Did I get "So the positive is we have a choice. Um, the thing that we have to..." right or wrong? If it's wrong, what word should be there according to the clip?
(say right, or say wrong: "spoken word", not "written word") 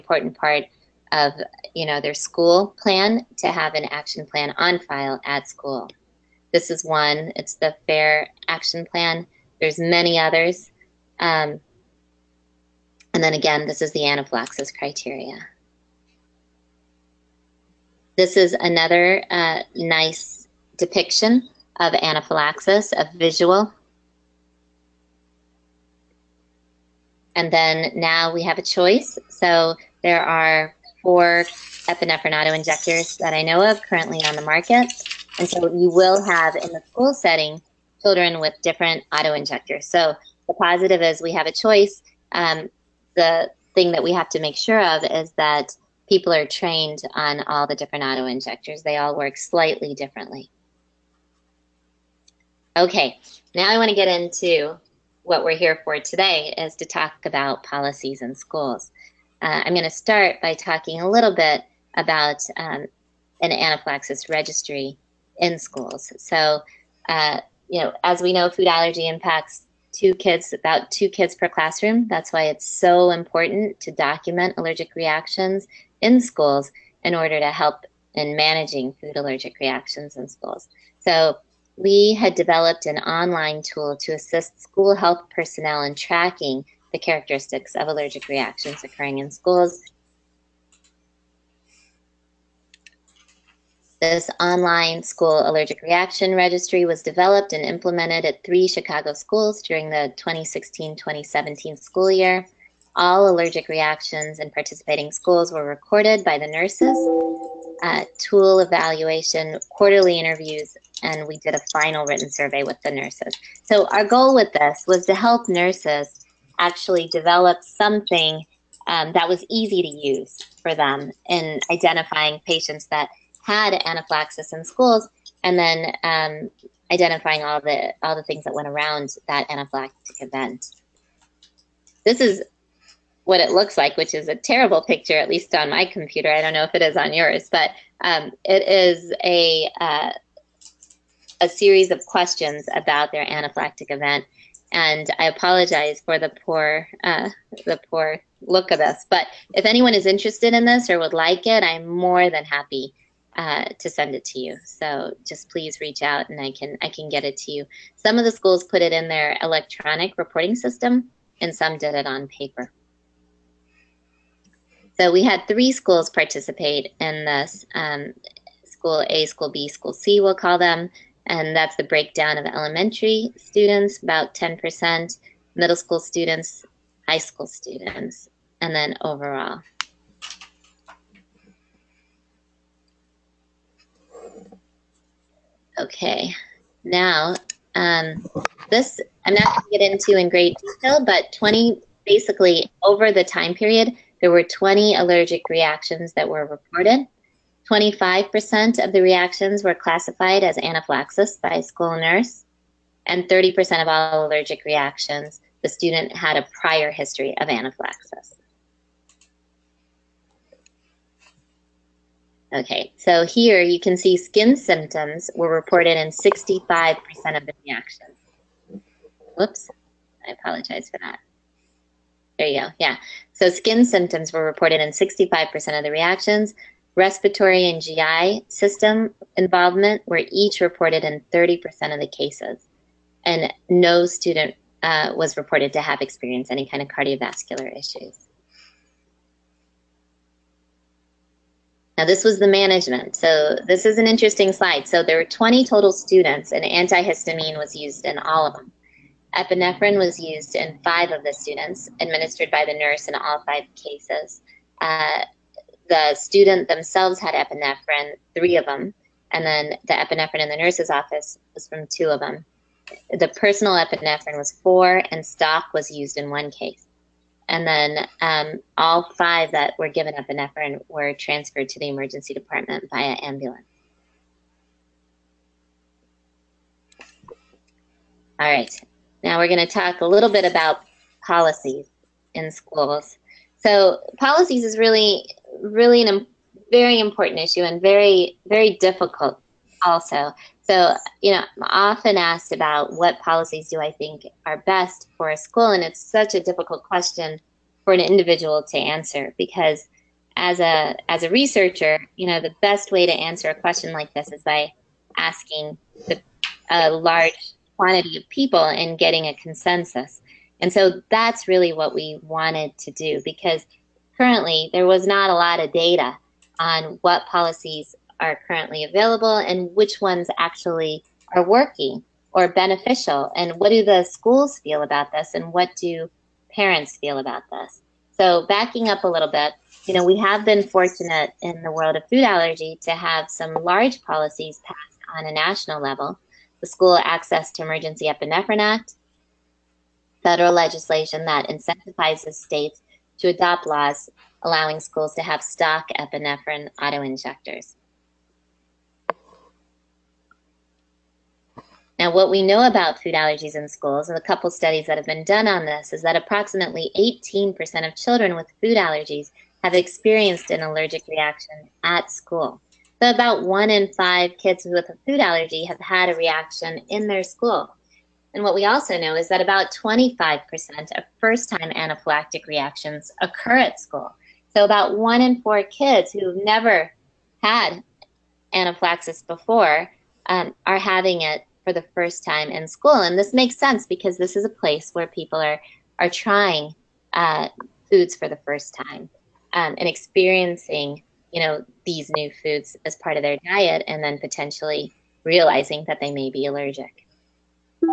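right.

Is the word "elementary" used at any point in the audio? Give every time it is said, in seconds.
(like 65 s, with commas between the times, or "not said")
172 s.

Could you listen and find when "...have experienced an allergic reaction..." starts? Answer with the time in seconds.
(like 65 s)
359 s.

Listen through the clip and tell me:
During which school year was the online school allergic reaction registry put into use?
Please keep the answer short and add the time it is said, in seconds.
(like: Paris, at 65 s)
2016-2017, at 100 s.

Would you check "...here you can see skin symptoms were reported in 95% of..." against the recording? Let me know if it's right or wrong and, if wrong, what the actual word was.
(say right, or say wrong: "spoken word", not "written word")
wrong: "65", not "95".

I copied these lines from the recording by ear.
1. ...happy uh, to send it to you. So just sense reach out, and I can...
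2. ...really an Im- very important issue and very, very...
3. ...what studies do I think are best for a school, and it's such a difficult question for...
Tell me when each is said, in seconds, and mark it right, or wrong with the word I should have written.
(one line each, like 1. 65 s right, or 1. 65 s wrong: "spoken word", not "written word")
1. 152 s wrong: "please", not "sense"
2. 285 s right
3. 292 s wrong: "policies", not "studies".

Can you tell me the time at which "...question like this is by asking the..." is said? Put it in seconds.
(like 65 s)
303 s.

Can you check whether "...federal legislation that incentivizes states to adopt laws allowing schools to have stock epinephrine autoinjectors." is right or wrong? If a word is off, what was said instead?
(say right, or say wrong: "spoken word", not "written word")
right.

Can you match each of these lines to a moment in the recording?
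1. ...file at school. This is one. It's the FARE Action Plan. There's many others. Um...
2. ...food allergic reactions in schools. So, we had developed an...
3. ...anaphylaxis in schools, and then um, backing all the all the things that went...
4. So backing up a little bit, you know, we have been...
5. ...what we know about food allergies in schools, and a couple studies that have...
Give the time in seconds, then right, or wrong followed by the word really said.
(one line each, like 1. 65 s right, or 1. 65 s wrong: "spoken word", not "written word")
1. 4 s right
2. 78 s right
3. 123 s wrong: "identifying", not "backing"
4. 328 s right
5. 352 s right.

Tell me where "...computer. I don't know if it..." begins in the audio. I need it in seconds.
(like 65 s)
135 s.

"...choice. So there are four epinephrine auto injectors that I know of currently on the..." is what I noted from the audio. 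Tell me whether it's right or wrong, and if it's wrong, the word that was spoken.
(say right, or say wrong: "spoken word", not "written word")
right.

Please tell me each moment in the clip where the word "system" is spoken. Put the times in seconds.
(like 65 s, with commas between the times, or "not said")
160 s, 228 s.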